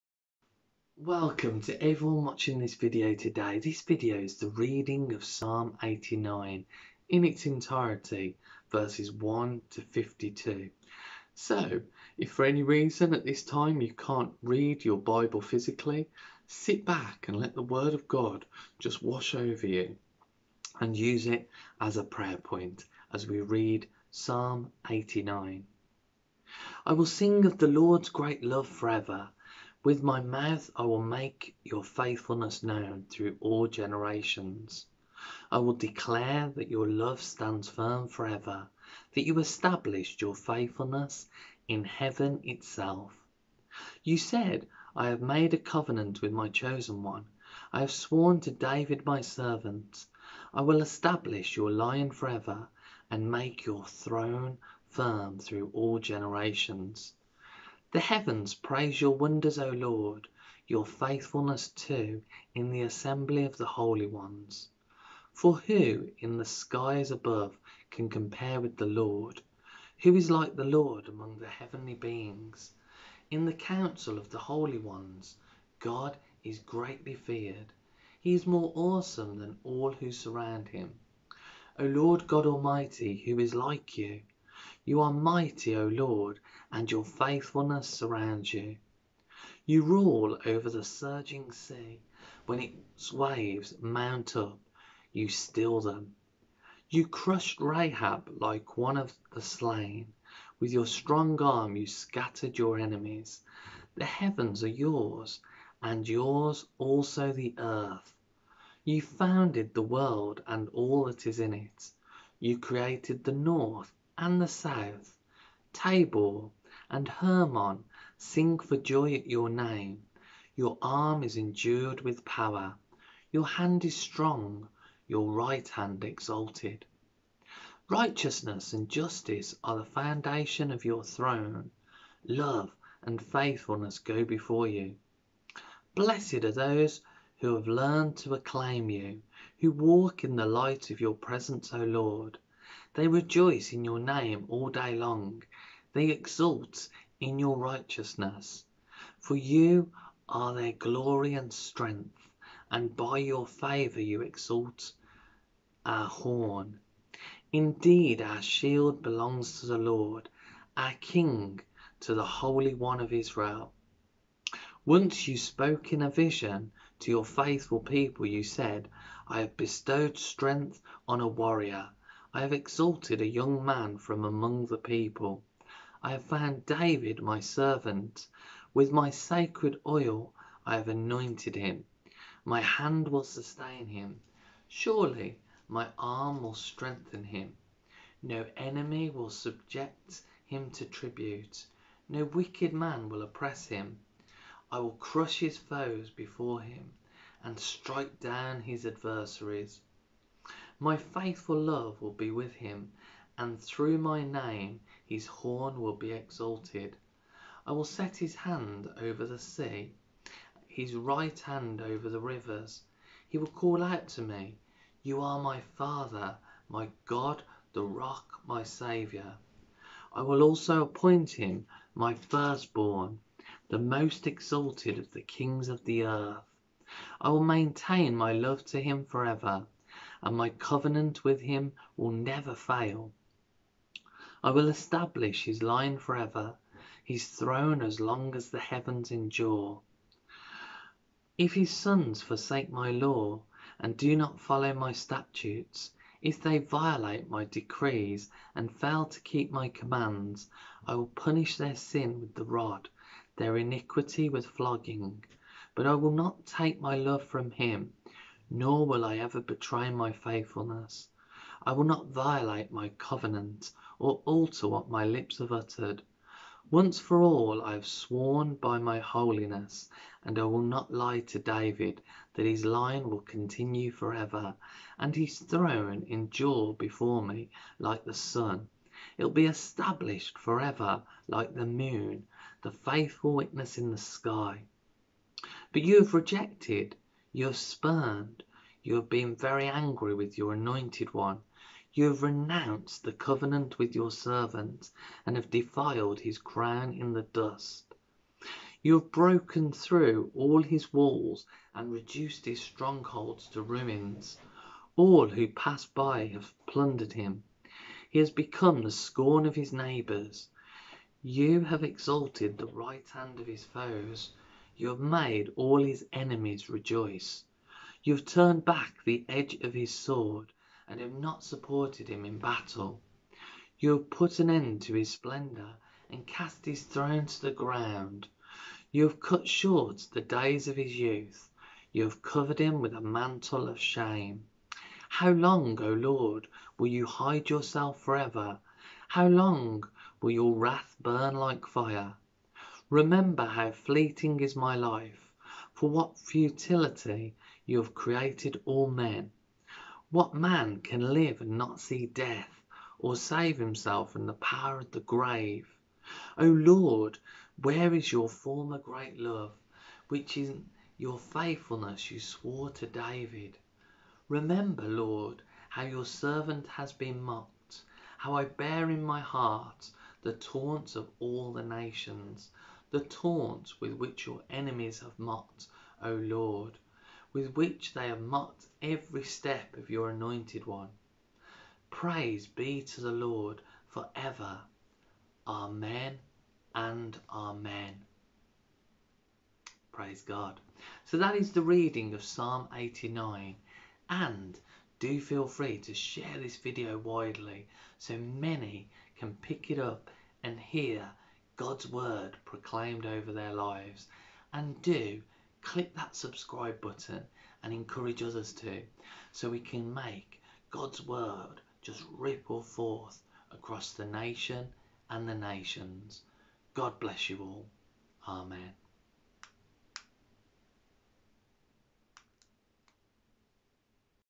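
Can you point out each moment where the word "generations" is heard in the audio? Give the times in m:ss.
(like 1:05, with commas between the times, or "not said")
0:33, 0:55.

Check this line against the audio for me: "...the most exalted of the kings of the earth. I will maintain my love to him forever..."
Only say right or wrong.
right.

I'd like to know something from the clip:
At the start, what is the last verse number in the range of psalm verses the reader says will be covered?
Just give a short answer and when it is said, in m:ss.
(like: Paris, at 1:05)
52, at 0:09.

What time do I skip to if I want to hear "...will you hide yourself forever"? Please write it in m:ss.
5:36.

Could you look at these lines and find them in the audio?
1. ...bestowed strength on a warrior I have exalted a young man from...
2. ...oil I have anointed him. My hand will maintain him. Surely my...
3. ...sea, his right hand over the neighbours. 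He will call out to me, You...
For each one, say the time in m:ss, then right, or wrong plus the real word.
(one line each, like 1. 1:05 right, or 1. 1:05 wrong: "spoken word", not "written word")
1. 2:49 right
2. 2:59 wrong: "sustain", not "maintain"
3. 3:29 wrong: "rivers", not "neighbours".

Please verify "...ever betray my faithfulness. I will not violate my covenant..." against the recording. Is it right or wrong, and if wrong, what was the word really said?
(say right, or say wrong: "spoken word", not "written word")
right.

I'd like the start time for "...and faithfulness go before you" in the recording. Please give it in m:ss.
2:13.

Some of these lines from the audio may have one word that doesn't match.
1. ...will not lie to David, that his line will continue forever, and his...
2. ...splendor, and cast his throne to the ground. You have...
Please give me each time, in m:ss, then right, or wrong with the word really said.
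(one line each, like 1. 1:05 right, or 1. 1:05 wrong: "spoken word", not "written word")
1. 4:30 right
2. 5:25 right.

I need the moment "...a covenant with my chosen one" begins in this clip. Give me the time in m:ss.
0:45.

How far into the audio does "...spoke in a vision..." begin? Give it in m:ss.
2:45.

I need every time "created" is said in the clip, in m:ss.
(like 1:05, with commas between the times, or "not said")
1:52, 5:47.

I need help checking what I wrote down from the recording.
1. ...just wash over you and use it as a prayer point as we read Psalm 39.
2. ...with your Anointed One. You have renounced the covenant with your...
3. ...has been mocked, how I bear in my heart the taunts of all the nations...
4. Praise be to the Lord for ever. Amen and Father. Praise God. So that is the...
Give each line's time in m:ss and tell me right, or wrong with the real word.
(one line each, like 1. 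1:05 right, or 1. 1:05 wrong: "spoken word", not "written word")
1. 0:18 wrong: "89", not "39"
2. 4:50 right
3. 6:06 right
4. 6:21 wrong: "Amen", not "Father".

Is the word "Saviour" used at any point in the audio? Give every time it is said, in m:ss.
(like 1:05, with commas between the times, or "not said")
3:38.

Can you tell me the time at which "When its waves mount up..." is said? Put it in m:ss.
1:32.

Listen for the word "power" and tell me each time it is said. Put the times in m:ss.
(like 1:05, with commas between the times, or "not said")
2:02, 5:54.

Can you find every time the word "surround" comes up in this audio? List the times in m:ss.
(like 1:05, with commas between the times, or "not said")
1:20, 1:27.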